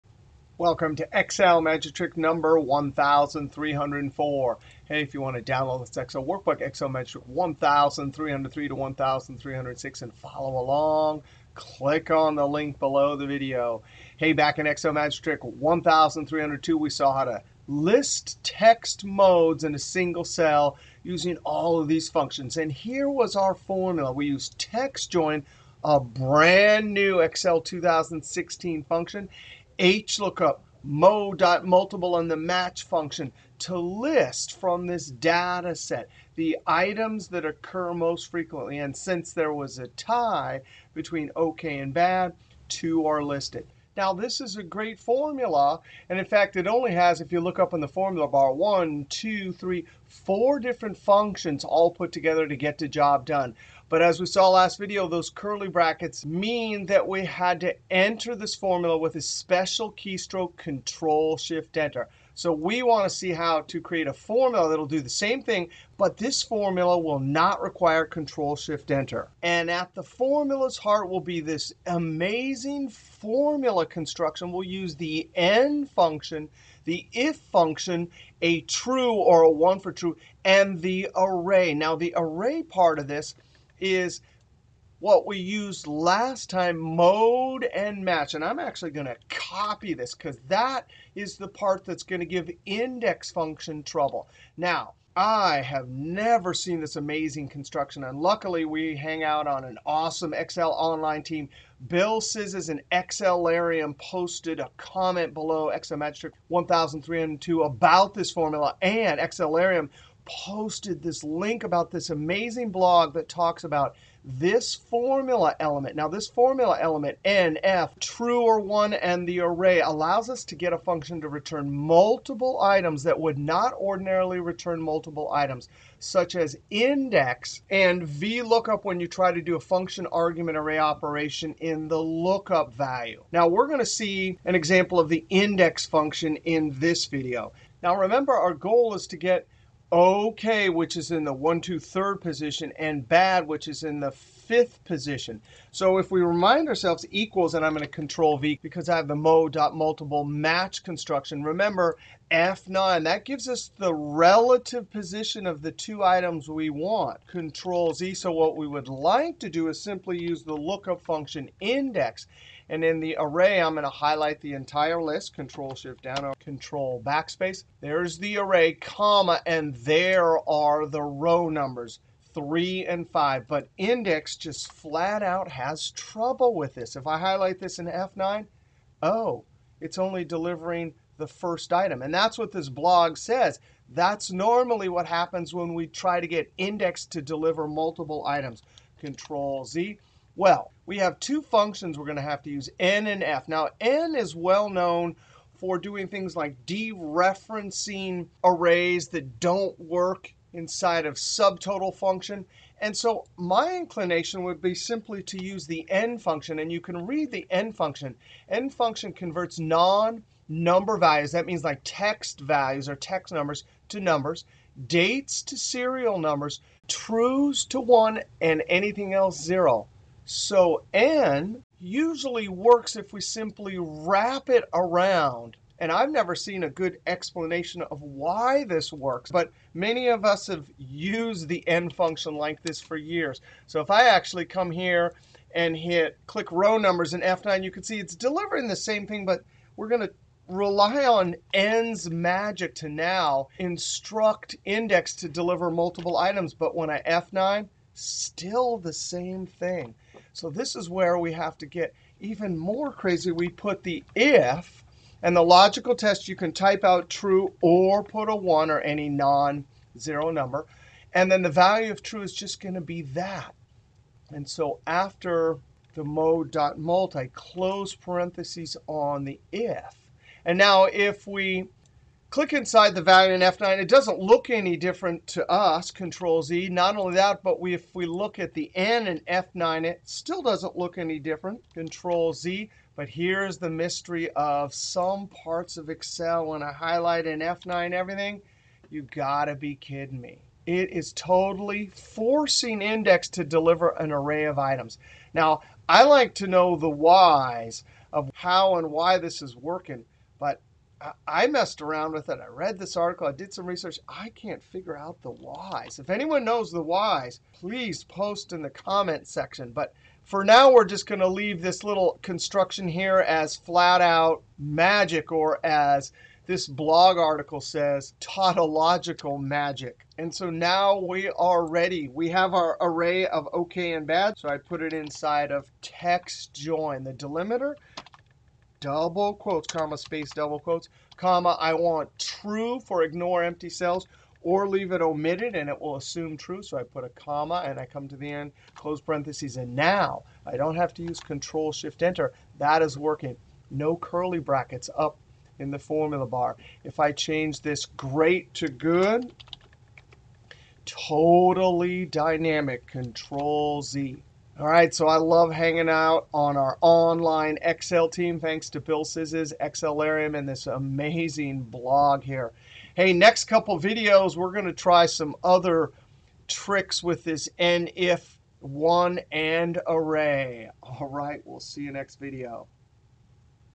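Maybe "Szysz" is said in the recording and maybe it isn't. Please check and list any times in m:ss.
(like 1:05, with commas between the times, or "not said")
1:42, 5:59.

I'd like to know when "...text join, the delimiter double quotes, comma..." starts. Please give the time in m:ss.
5:25.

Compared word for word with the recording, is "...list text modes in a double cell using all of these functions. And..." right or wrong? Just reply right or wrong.
wrong.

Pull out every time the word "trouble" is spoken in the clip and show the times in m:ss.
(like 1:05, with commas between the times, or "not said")
1:33, 2:55.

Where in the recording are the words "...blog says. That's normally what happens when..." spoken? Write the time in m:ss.
3:02.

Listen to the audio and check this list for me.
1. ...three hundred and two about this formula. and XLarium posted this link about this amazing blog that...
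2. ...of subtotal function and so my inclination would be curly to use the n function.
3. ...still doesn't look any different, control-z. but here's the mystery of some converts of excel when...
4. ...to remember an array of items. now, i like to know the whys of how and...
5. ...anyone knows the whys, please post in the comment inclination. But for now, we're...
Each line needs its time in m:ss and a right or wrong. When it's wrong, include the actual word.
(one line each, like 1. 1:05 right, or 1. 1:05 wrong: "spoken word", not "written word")
1. 1:47 right
2. 3:21 wrong: "simply", not "curly"
3. 4:40 wrong: "parts", not "converts"
4. 4:53 wrong: "deliver", not "remember"
5. 5:06 wrong: "section", not "inclination".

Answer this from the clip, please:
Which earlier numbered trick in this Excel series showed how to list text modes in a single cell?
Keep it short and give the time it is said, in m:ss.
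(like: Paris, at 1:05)
1302, at 0:14.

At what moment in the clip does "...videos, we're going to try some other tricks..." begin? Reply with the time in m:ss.
6:03.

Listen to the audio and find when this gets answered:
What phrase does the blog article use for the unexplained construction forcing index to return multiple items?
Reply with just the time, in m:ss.
5:18.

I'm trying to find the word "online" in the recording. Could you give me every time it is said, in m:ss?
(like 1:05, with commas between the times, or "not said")
1:40, 5:56.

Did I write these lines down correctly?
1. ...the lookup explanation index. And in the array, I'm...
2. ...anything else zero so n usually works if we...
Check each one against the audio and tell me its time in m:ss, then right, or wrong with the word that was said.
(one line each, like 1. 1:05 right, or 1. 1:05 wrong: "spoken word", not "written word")
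1. 2:40 wrong: "function", not "explanation"
2. 3:38 right.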